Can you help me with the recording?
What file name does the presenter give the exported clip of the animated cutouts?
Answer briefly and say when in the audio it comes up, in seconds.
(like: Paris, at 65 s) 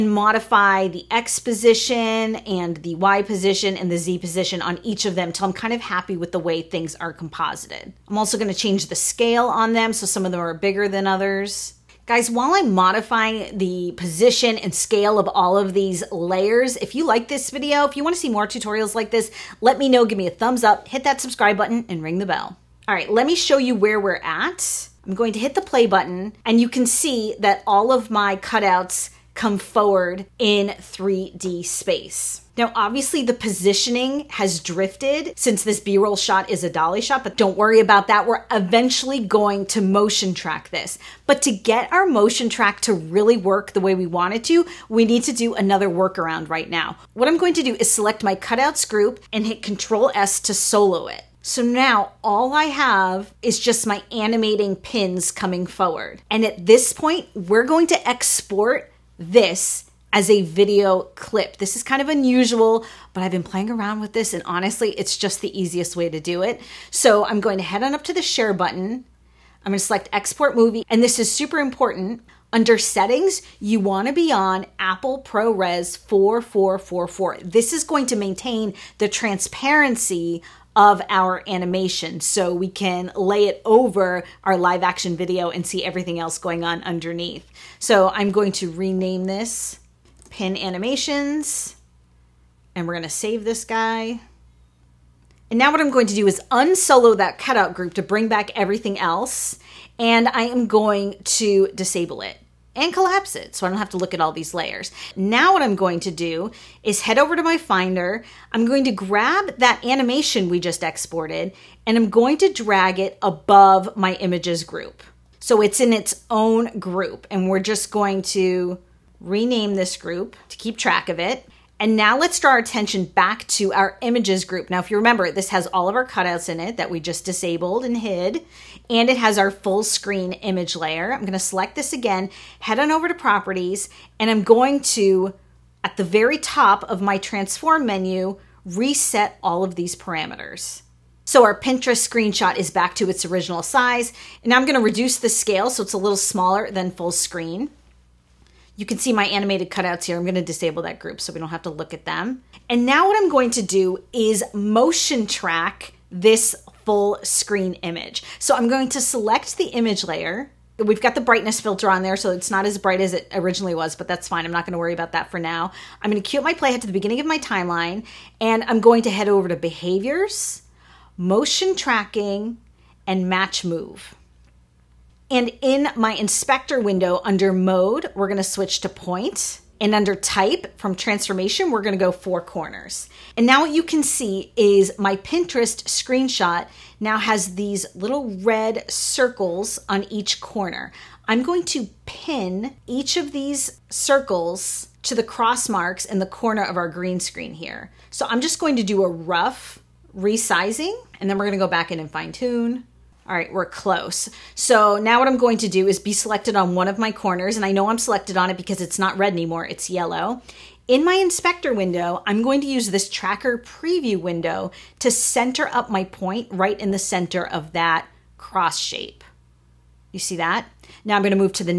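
pin animations, at 90 s.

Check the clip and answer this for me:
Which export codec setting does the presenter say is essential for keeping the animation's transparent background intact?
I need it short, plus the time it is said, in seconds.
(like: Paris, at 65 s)
Apple ProRes 4444, at 74 s.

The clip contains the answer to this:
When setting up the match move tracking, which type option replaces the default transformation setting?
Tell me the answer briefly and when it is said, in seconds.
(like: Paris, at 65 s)
four corners, at 182 s.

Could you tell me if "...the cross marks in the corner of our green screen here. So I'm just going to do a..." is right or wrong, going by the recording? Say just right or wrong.
right.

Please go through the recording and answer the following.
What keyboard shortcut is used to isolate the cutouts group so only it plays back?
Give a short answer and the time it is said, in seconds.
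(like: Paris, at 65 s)
Control S, at 49 s.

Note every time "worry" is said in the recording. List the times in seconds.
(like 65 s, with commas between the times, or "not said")
37 s, 164 s.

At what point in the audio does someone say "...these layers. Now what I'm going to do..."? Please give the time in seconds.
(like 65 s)
104 s.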